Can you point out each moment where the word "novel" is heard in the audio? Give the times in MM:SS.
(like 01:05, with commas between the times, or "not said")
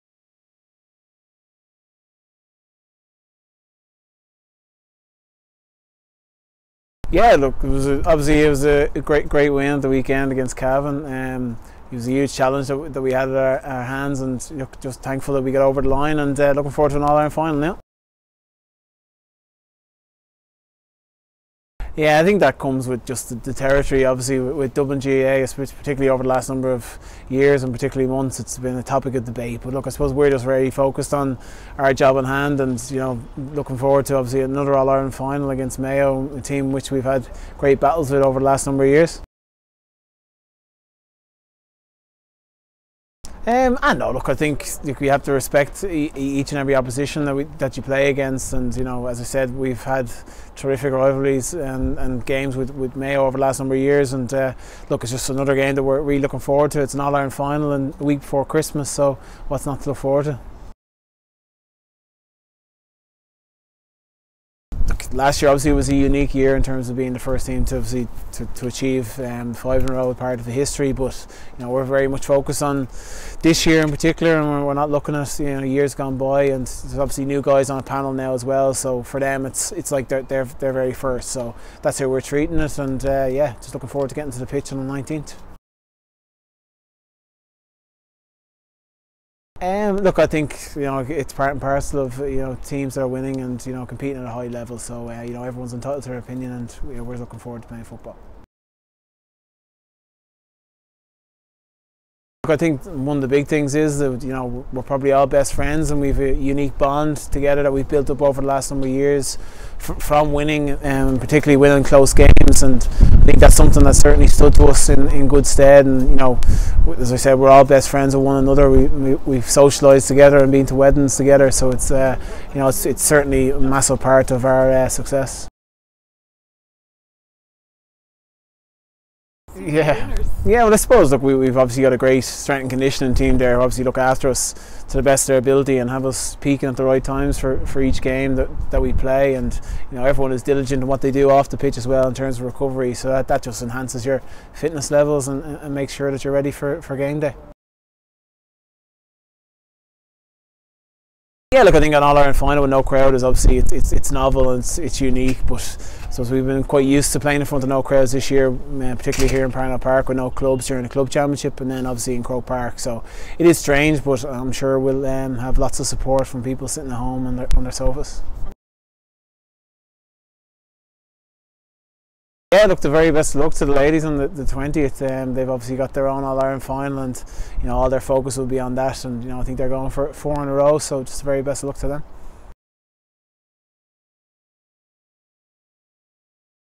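02:34.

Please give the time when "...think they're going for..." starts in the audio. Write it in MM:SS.
02:59.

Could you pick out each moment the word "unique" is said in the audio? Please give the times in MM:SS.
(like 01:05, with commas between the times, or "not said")
01:05, 01:46, 02:35.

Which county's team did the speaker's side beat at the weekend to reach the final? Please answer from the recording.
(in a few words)
Cavan.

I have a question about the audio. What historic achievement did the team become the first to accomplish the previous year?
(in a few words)
five in a row.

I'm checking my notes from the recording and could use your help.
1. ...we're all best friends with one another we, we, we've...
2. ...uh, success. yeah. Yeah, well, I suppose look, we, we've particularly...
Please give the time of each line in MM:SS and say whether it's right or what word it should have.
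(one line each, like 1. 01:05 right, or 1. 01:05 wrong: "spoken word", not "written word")
1. 01:57 right
2. 02:04 wrong: "obviously", not "particularly".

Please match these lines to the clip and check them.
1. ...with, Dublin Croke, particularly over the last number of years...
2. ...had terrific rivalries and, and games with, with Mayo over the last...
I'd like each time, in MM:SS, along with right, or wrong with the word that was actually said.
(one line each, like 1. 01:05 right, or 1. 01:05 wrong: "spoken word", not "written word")
1. 00:24 wrong: "GAA", not "Croke"
2. 00:49 right.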